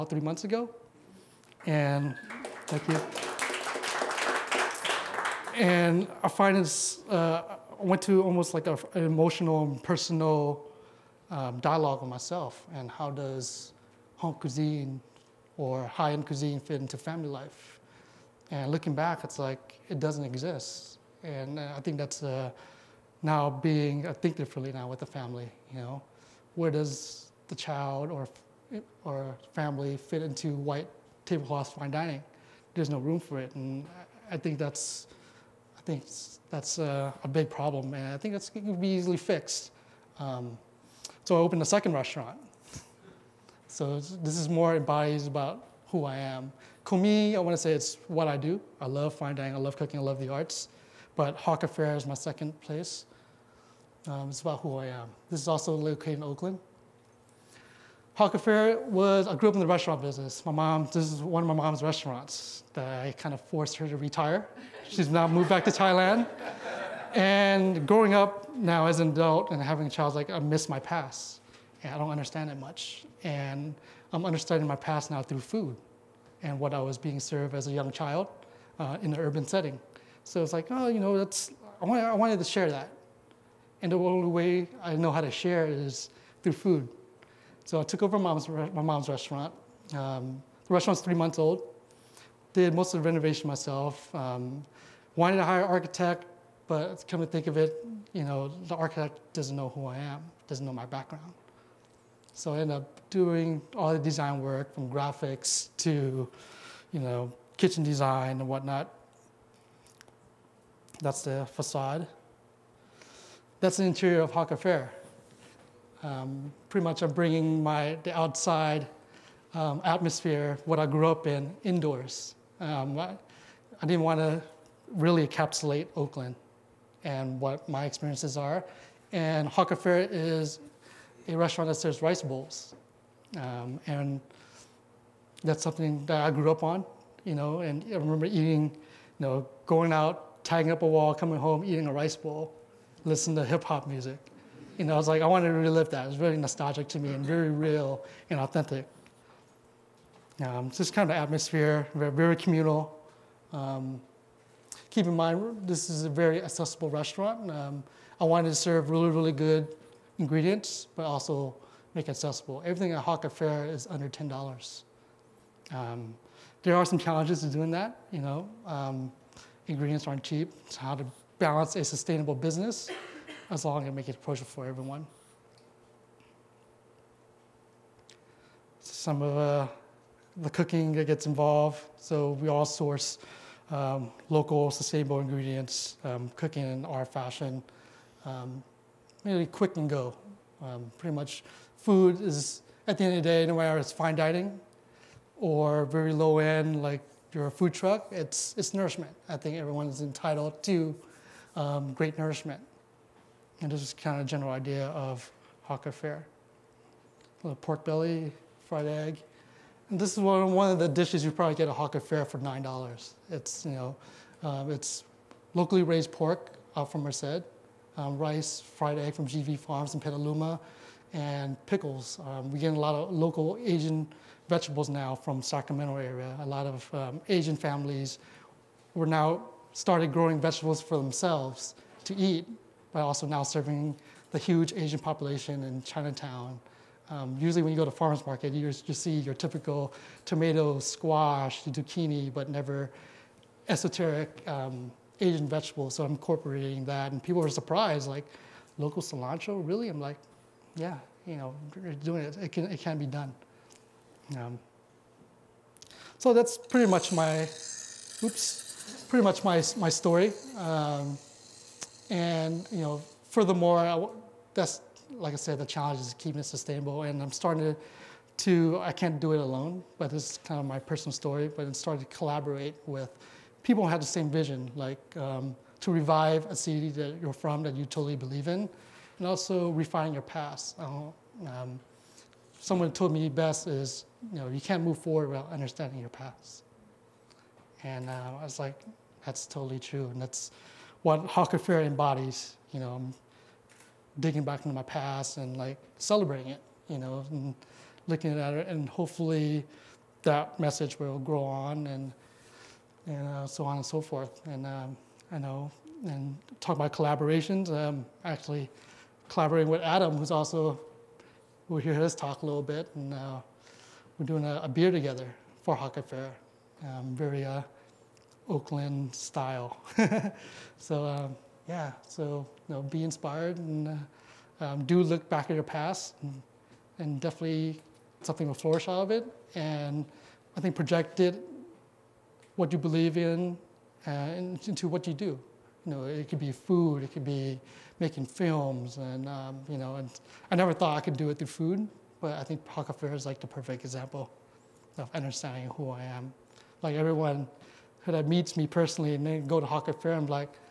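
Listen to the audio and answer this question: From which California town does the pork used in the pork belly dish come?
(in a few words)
Merced.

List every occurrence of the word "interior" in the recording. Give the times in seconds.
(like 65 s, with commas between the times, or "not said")
113 s.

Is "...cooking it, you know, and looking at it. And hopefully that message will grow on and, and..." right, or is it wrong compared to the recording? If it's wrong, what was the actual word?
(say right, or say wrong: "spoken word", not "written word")
wrong: "celebrating", not "cooking".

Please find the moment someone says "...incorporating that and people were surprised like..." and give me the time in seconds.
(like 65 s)
246 s.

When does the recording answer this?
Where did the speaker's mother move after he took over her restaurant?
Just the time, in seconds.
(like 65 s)
65 s.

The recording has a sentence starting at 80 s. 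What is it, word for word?
So it's like, oh, you know, that's, I, I wanted to share that.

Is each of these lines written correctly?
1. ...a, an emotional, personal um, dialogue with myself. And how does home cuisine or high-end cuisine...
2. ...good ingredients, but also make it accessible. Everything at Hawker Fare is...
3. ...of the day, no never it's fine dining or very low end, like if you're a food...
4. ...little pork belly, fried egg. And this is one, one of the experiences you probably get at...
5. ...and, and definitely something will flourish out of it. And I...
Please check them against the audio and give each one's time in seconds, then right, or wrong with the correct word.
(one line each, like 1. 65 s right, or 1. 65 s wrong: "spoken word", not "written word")
1. 8 s right
2. 159 s right
3. 193 s wrong: "matter", not "never"
4. 207 s wrong: "dishes", not "experiences"
5. 326 s right.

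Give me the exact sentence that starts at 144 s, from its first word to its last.
You know, I was like, I wanted to relive that.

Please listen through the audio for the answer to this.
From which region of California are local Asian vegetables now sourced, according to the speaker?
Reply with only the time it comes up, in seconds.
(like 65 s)
225 s.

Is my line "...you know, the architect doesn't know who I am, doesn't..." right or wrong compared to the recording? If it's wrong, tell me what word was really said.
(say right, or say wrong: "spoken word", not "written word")
right.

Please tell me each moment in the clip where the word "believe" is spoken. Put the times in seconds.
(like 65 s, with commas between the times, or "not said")
278 s, 332 s.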